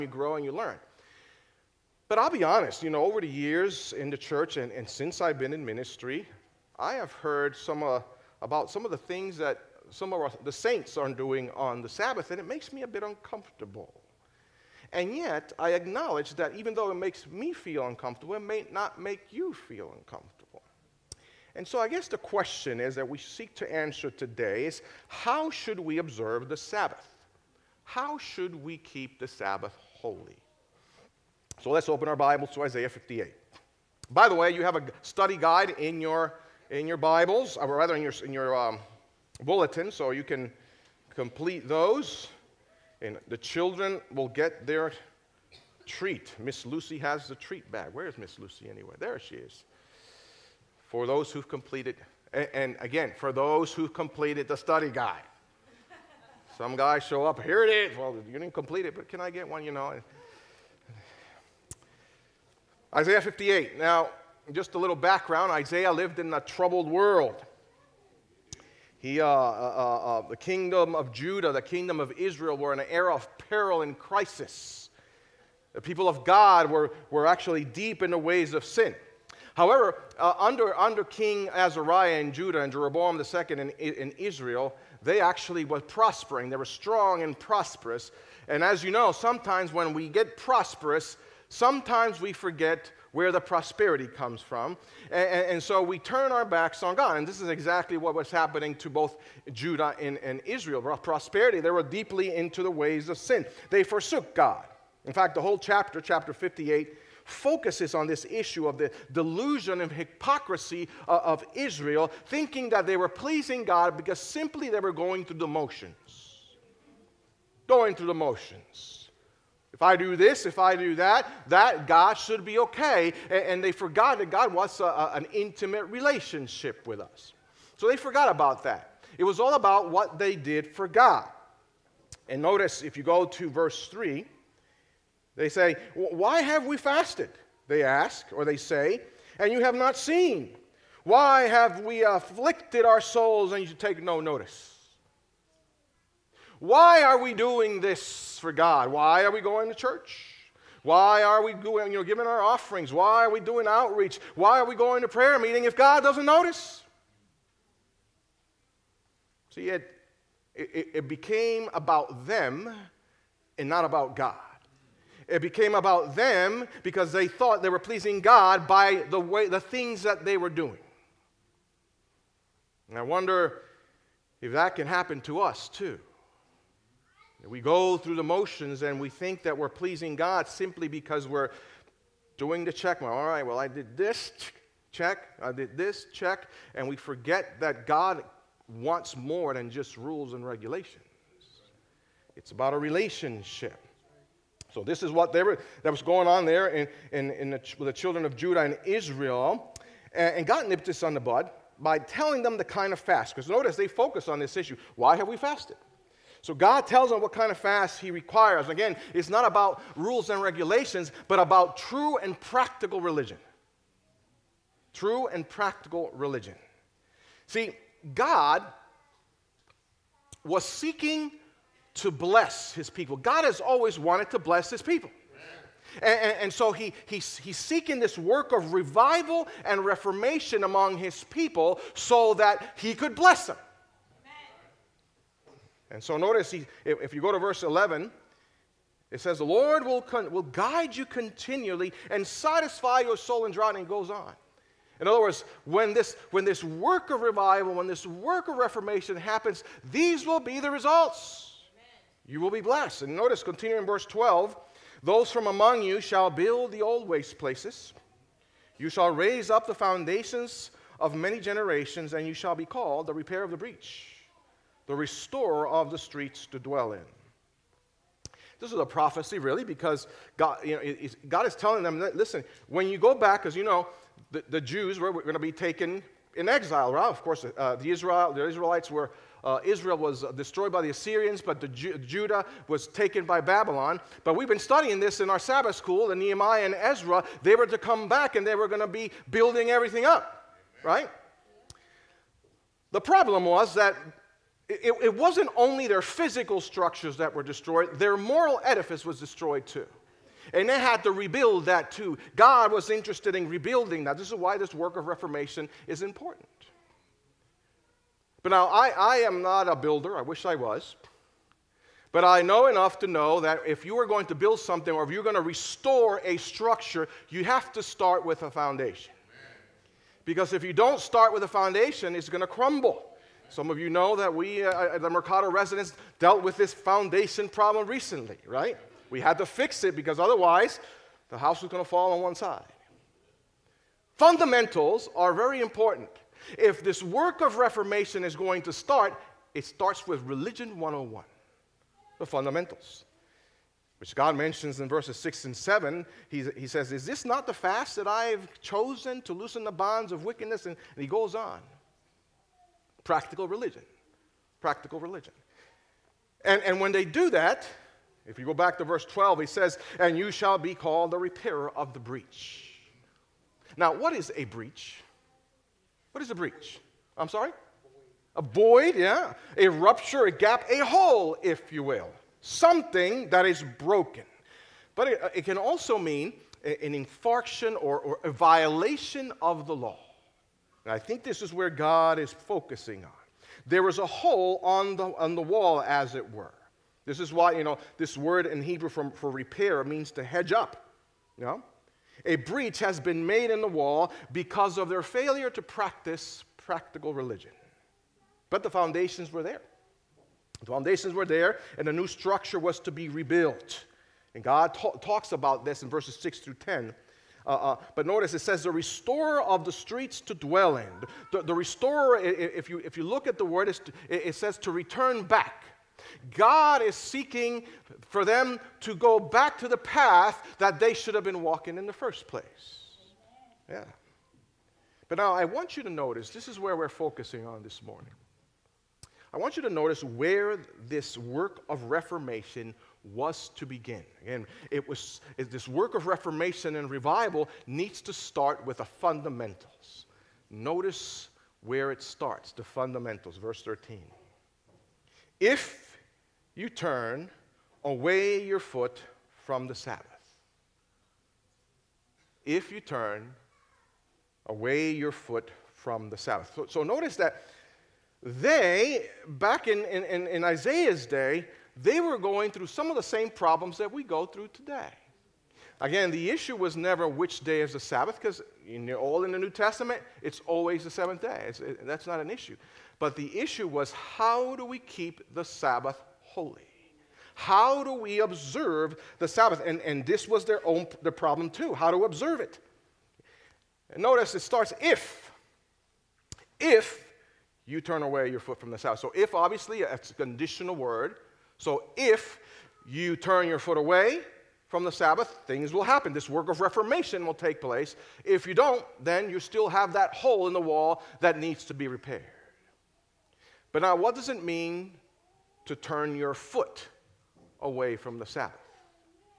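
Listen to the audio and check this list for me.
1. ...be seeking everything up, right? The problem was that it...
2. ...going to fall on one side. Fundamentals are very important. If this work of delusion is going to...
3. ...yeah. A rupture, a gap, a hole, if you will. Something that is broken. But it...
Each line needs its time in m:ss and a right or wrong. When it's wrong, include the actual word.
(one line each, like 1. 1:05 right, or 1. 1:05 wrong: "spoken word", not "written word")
1. 4:48 wrong: "building", not "seeking"
2. 5:31 wrong: "reformation", not "delusion"
3. 6:08 right.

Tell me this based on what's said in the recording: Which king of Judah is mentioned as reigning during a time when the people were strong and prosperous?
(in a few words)
King Azariah.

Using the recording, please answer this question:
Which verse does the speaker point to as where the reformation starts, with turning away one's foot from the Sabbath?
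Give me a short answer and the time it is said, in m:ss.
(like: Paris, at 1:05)
verse 13, at 7:23.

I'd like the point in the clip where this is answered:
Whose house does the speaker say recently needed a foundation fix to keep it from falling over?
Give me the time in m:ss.
5:25.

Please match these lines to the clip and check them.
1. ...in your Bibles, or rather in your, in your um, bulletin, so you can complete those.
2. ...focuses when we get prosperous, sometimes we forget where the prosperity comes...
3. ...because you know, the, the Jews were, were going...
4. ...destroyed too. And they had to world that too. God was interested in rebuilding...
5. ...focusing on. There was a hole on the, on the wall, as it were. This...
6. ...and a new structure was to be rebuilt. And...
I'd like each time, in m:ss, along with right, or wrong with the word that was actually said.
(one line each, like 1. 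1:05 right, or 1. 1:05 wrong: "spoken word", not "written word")
1. 0:36 right
2. 1:29 wrong: "sometimes", not "focuses"
3. 4:33 right
4. 4:59 wrong: "rebuild", not "world"
5. 6:22 right
6. 6:41 right.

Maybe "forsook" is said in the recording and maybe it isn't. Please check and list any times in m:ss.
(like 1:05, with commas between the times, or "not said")
1:43.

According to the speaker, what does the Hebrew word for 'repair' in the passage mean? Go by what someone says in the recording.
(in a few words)
to hedge up.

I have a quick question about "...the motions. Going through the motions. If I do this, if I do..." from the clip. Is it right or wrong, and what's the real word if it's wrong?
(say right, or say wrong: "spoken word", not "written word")
right.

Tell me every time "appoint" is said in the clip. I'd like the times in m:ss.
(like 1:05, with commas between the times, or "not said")
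not said.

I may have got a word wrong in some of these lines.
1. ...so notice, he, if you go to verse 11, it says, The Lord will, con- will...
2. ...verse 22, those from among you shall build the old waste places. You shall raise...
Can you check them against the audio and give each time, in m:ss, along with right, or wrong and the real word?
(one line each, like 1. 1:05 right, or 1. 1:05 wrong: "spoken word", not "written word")
1. 3:56 right
2. 4:13 wrong: "12", not "22".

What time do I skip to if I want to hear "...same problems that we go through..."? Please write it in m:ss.
7:43.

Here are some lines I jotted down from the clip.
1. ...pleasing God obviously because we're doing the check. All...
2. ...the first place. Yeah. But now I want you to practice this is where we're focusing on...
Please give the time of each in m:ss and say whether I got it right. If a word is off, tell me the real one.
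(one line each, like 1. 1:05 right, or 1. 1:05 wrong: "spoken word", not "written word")
1. 2:59 wrong: "simply", not "obviously"
2. 7:01 wrong: "notice", not "practice".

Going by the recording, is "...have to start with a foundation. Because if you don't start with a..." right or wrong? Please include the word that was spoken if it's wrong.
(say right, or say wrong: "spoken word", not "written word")
right.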